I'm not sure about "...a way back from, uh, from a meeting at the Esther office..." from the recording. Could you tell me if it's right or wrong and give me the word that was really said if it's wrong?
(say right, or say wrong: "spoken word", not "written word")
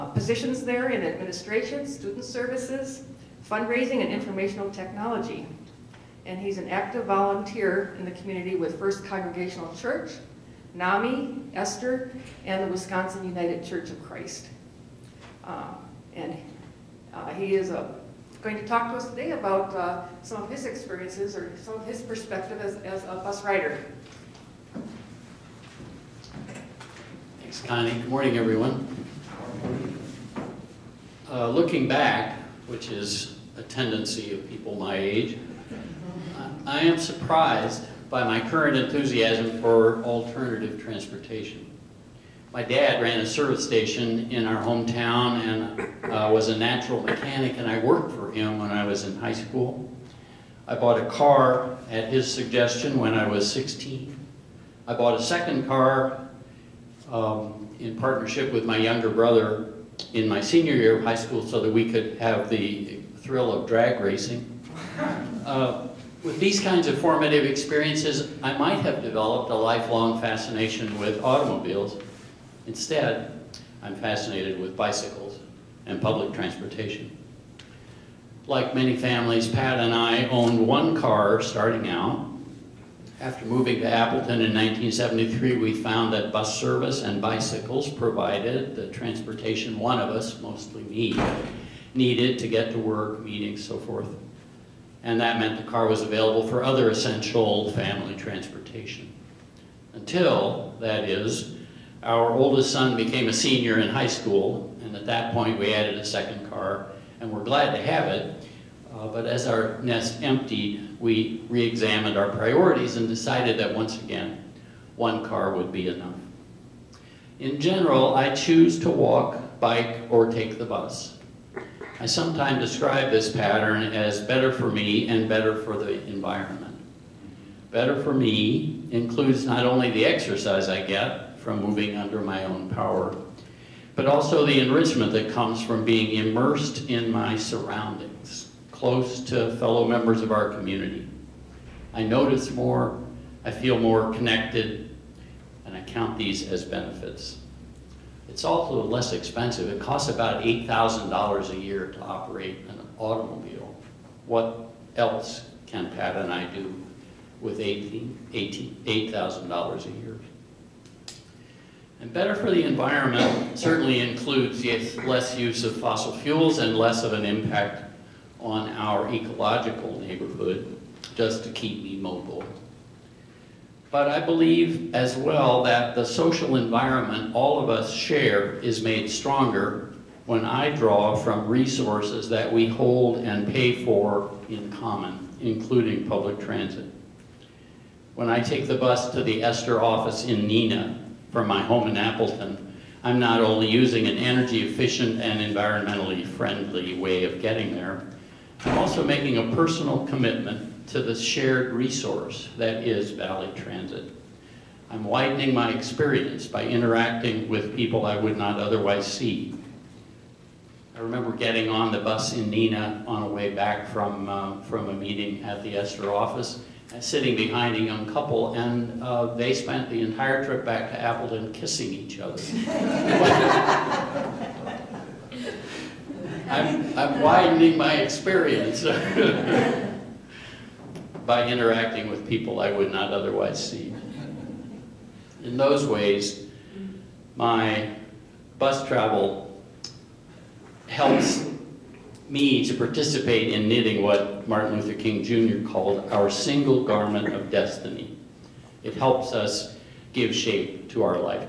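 right.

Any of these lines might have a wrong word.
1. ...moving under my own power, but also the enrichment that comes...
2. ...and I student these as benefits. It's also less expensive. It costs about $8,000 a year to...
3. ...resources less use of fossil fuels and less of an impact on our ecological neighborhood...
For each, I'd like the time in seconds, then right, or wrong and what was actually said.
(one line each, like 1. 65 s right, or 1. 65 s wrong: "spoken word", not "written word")
1. 131 s right
2. 145 s wrong: "count", not "student"
3. 163 s wrong: "includes", not "resources".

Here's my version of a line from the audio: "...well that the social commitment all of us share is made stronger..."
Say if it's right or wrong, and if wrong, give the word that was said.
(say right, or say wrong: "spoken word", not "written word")
wrong: "environment", not "commitment".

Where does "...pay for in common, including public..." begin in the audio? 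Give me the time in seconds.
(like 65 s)
183 s.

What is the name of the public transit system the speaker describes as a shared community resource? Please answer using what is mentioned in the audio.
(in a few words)
Valley Transit.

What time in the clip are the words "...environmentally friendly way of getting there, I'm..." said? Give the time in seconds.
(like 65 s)
195 s.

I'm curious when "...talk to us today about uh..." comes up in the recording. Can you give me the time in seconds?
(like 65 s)
18 s.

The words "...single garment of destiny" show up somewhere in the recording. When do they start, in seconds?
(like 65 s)
246 s.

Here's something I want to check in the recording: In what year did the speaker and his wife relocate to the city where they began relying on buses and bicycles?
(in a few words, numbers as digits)
1973.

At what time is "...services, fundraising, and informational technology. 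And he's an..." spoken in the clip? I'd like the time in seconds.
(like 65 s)
2 s.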